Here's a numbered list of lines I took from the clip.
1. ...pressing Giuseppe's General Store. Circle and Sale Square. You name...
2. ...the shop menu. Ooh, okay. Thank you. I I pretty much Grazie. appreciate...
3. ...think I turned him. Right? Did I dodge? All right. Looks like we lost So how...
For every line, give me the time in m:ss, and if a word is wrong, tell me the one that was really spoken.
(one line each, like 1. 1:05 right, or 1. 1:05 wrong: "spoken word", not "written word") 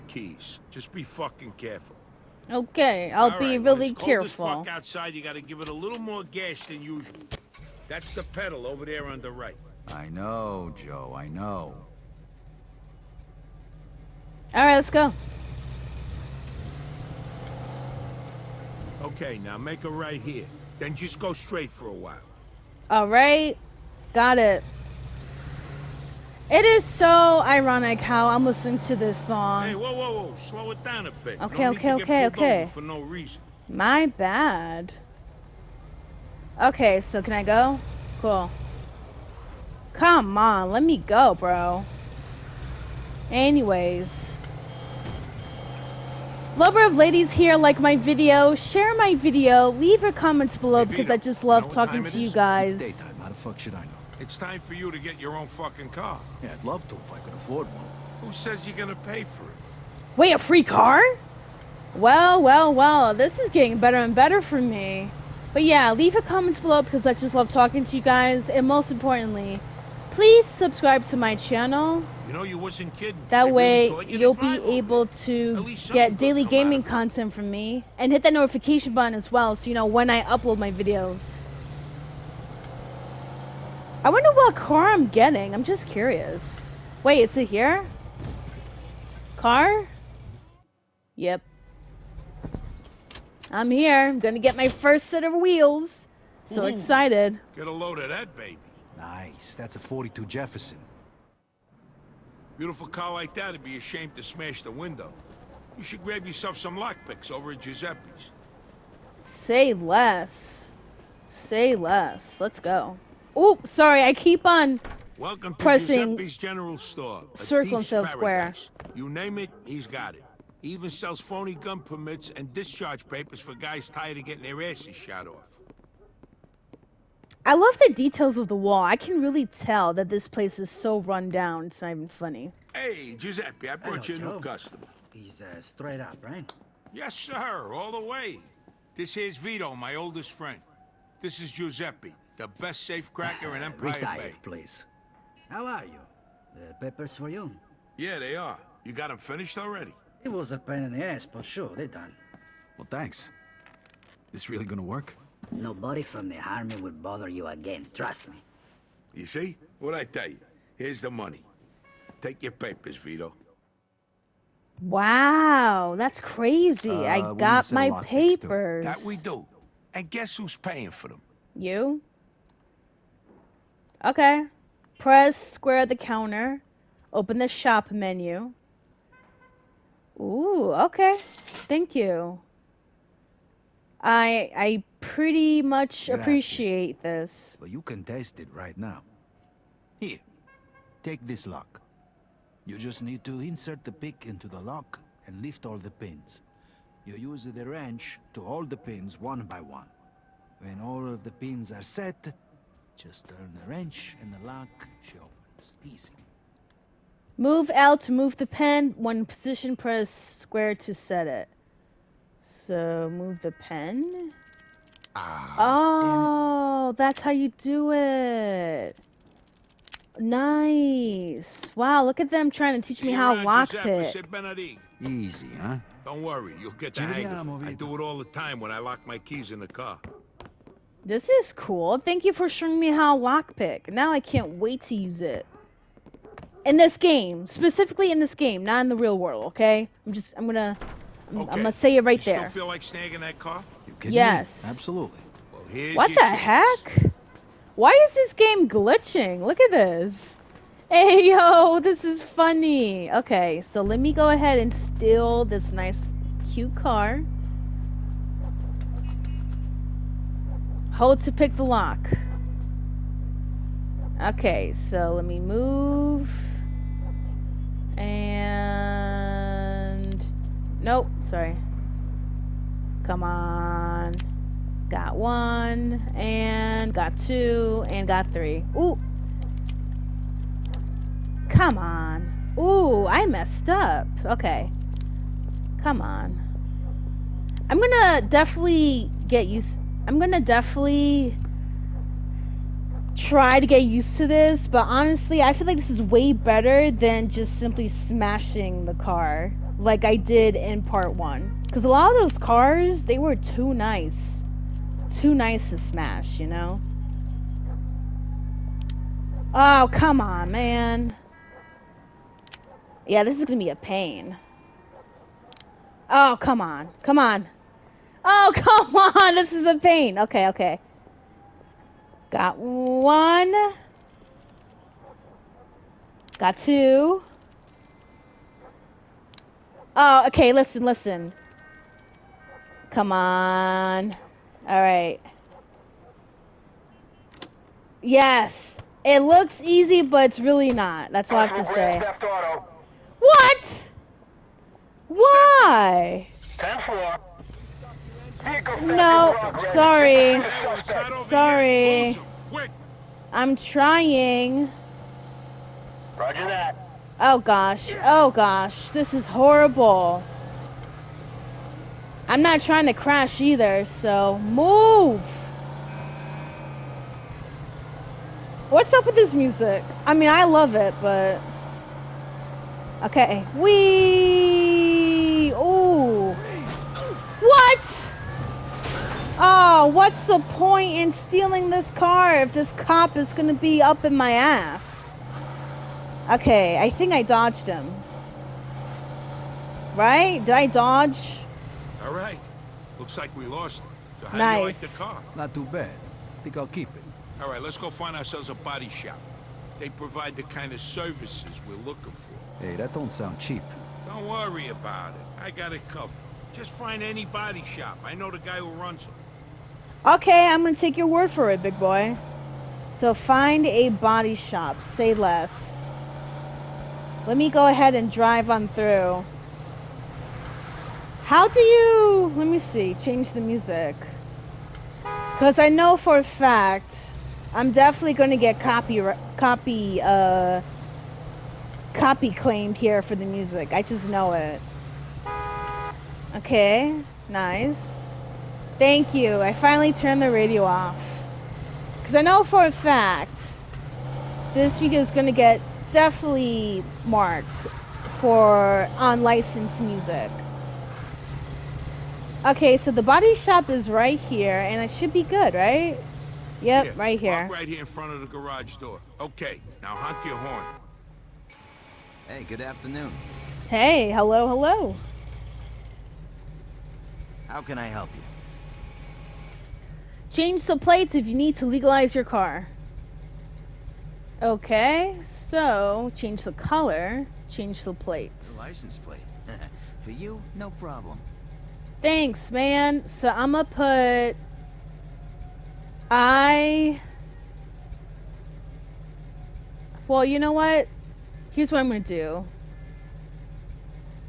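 1. 1:55 right
2. 2:57 right
3. 6:26 wrong: "dodged", not "turned".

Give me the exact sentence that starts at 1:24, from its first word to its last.
I wonder what car I'm getting.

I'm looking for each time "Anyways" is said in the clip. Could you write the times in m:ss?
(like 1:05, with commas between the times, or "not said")
0:43.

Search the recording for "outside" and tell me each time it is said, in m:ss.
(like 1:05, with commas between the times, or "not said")
0:04.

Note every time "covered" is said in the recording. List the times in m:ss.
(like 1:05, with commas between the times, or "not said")
6:45.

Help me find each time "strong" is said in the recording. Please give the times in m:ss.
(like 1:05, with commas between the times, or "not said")
not said.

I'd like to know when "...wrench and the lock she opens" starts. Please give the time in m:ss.
3:23.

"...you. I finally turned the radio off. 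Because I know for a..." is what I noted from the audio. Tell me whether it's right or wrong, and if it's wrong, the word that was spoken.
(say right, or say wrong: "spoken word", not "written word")
right.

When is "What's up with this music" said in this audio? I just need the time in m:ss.
6:08.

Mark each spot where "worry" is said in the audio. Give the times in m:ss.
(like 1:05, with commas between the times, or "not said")
3:46, 6:44.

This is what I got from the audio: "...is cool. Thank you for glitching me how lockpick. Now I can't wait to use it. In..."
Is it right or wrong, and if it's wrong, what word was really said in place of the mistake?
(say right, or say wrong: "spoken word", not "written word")
wrong: "showing", not "glitching".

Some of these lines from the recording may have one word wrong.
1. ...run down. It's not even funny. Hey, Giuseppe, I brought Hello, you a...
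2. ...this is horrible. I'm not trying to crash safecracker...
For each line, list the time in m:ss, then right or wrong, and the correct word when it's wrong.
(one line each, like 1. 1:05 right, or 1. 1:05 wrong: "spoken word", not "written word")
1. 2:11 right
2. 5:58 wrong: "either", not "safecracker".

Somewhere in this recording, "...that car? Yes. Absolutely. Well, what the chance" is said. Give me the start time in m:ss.
4:03.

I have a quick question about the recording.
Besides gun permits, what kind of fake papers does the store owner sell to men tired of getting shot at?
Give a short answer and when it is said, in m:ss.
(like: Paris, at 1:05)
Discharge papers, at 2:02.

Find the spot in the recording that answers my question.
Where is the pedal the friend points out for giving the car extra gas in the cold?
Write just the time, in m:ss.
0:09.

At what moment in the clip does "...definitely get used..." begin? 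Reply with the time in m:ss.
4:48.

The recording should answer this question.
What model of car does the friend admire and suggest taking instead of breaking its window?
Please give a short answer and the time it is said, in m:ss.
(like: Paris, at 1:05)
42 Jefferson, at 1:39.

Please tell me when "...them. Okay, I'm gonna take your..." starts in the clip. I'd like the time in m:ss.
6:49.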